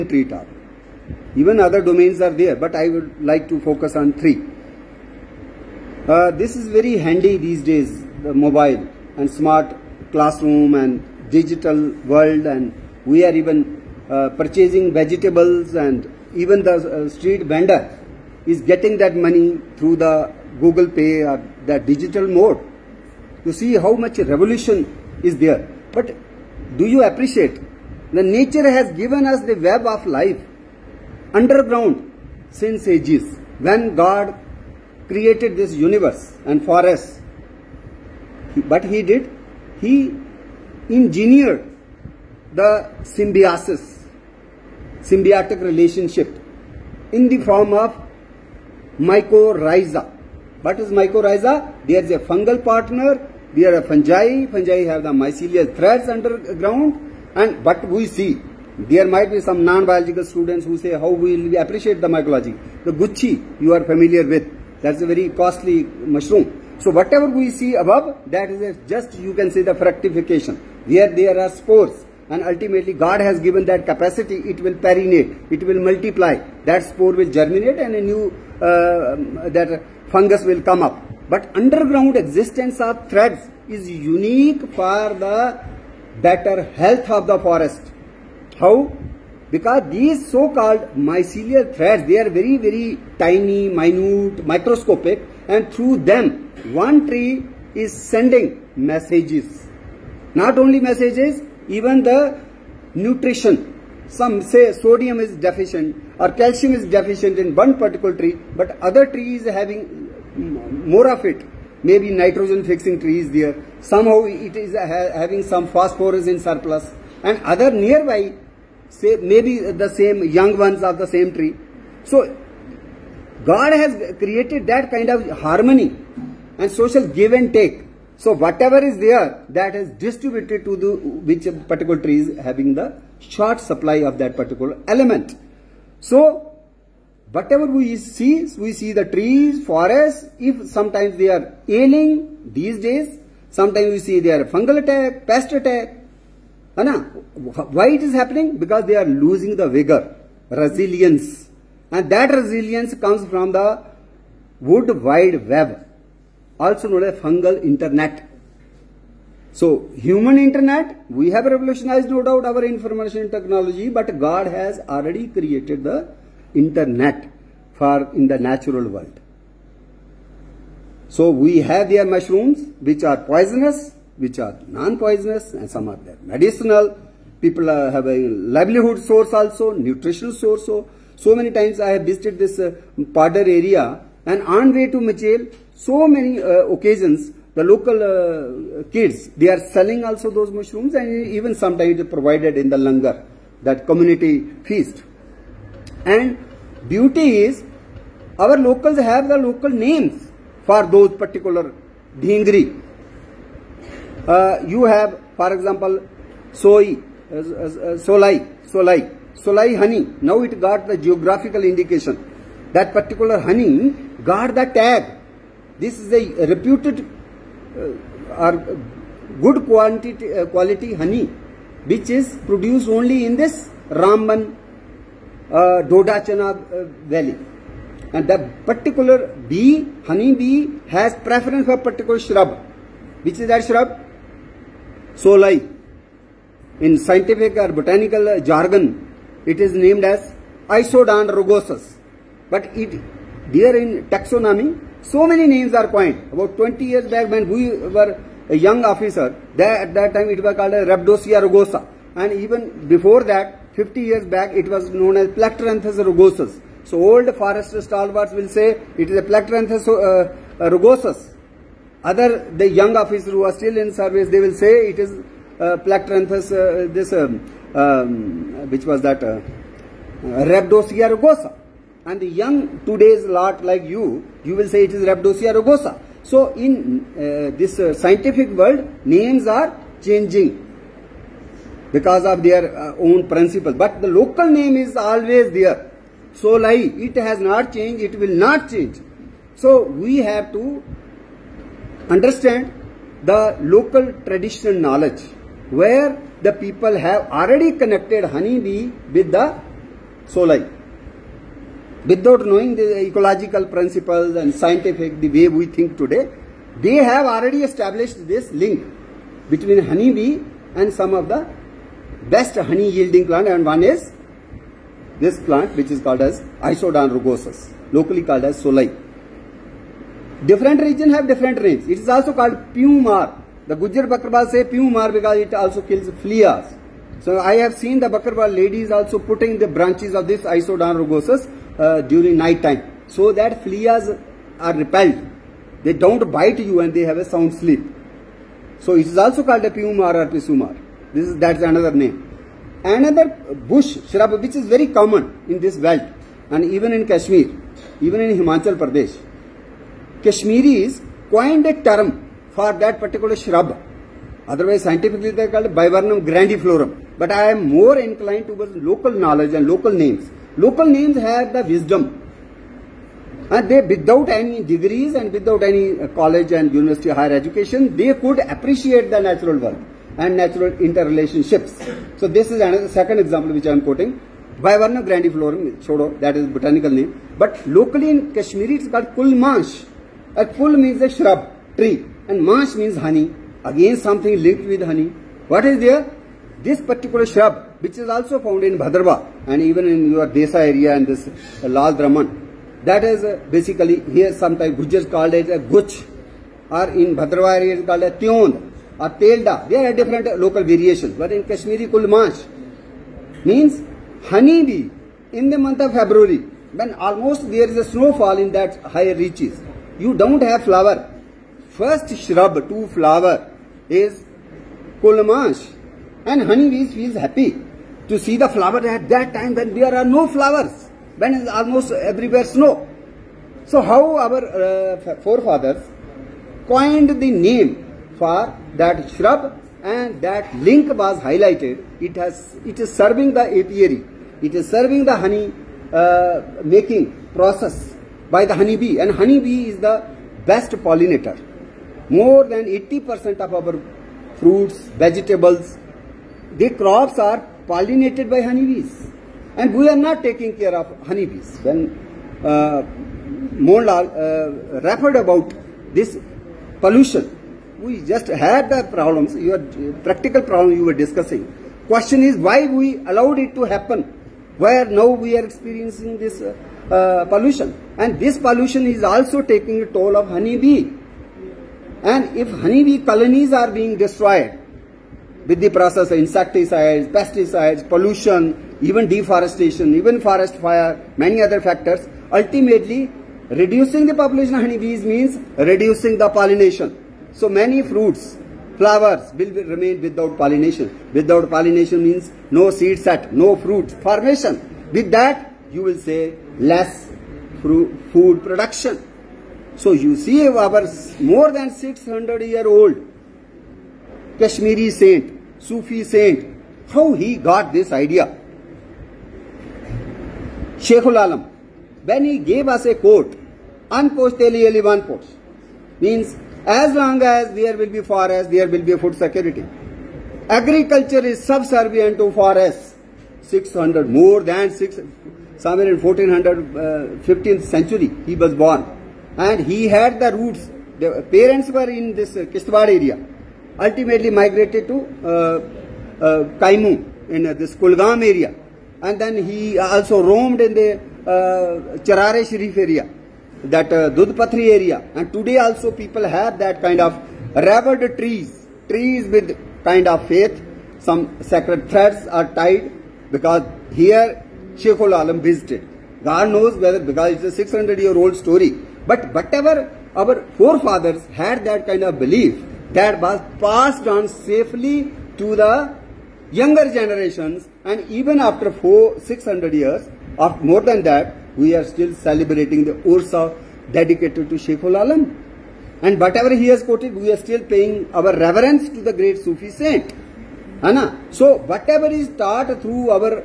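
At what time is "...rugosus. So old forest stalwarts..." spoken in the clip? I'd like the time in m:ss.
4:16.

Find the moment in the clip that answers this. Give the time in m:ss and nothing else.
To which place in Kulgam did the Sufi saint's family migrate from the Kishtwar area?
8:56.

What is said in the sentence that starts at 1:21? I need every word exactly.
But underground existence of threads is unique for the better health of the forest.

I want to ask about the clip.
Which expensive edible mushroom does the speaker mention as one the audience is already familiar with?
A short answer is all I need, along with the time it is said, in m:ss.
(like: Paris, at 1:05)
Gucchi, at 1:02.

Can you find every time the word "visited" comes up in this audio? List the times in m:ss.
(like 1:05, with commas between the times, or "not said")
3:02, 9:15.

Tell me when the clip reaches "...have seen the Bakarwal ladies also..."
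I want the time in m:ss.
5:27.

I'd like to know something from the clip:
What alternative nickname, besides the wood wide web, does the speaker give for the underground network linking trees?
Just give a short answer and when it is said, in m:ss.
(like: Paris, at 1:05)
Fungal internet, at 2:37.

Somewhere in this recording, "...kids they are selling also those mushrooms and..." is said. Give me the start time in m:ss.
3:08.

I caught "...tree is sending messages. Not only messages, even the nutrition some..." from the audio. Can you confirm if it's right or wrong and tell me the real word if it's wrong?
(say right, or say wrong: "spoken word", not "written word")
right.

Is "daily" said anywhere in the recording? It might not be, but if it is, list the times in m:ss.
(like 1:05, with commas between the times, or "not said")
not said.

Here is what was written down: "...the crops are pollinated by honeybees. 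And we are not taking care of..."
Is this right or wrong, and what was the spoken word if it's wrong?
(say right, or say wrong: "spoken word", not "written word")
right.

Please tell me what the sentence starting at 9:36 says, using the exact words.
And whatever he has quoted, we are still paying our reverence to the great Sufi saint.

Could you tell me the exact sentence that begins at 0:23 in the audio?
You see how much revolution is there.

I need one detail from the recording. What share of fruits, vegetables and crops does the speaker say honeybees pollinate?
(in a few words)
More than 80%.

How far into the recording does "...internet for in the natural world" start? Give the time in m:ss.
2:46.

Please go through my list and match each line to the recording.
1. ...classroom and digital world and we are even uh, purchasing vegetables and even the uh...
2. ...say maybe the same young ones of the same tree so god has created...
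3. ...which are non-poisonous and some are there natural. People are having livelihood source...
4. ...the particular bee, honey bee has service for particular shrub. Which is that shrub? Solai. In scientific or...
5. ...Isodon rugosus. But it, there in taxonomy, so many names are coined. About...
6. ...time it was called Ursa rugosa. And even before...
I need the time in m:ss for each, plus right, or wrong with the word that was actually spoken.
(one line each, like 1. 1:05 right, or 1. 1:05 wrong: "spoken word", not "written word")
1. 0:10 right
2. 1:58 right
3. 2:54 wrong: "medicinal", not "natural"
4. 3:48 wrong: "preference", not "service"
5. 4:00 right
6. 4:10 wrong: "Rabdosia", not "Ursa".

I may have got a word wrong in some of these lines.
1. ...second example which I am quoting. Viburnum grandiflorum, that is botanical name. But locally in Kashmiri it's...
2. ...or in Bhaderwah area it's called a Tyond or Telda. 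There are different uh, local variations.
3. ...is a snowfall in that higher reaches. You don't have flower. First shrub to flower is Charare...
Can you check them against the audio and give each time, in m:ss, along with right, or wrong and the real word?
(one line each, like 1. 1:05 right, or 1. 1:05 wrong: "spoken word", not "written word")
1. 6:12 right
2. 6:36 right
3. 6:47 wrong: "Kulmash", not "Charare".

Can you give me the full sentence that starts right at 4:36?
So in uh, this uh, scientific world, names are changing because of their uh, own principle.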